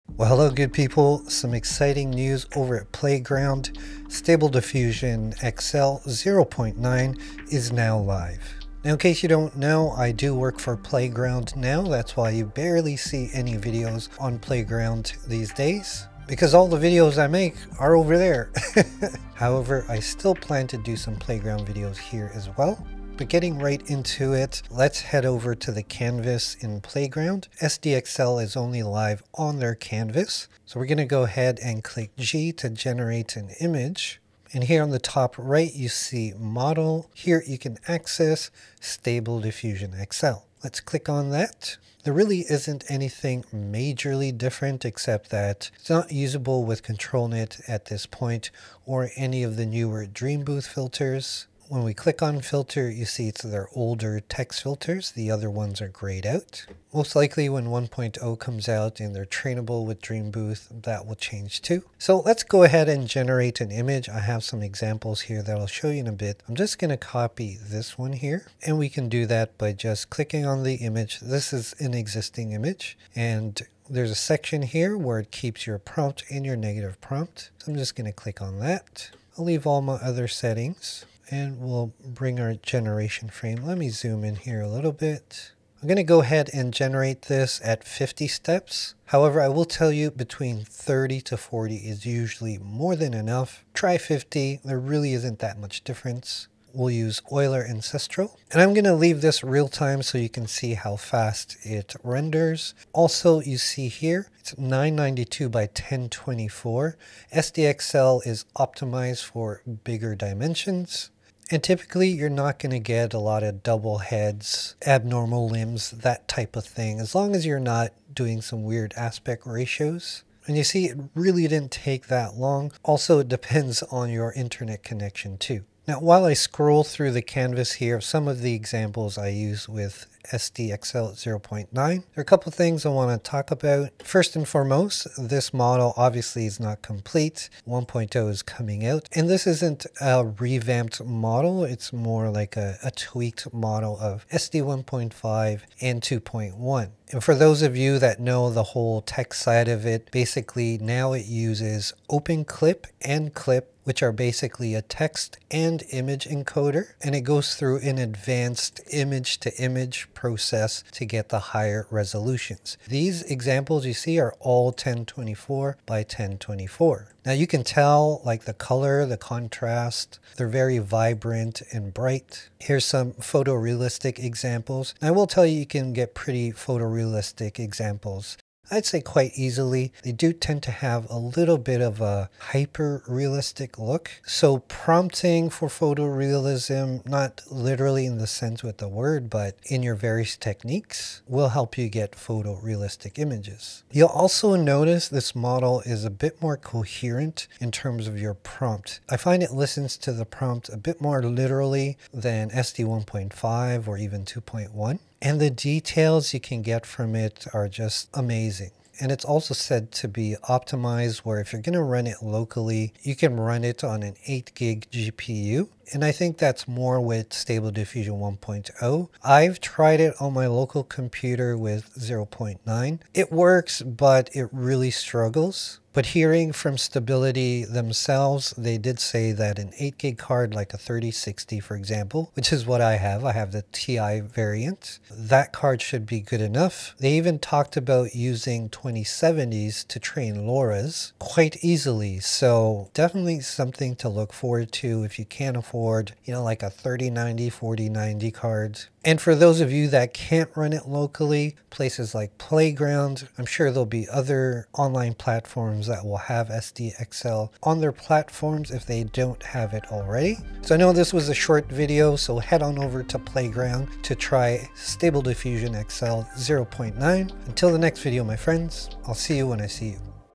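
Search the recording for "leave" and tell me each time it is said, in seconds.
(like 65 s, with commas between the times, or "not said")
79 s, 98 s.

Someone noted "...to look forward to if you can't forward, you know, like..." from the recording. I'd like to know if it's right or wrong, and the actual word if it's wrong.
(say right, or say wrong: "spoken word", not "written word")
wrong: "afford", not "forward".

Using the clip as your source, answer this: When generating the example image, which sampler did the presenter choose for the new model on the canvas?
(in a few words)
Euler Ancestral.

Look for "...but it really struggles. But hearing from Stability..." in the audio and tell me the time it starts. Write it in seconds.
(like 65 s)
223 s.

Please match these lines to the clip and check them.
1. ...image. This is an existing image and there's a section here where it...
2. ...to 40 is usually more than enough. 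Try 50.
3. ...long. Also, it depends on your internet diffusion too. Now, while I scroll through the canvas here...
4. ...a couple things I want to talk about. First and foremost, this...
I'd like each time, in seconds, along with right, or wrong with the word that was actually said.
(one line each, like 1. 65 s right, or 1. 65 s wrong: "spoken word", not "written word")
1. 70 s right
2. 91 s right
3. 122 s wrong: "connection", not "diffusion"
4. 132 s right.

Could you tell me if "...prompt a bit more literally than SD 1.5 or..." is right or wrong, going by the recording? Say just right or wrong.
right.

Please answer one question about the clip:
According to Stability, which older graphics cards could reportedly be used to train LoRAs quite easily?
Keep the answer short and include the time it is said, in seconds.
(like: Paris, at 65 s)
2070s, at 238 s.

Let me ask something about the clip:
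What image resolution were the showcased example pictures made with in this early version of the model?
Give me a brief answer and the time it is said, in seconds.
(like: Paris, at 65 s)
1024 by 1024, at 164 s.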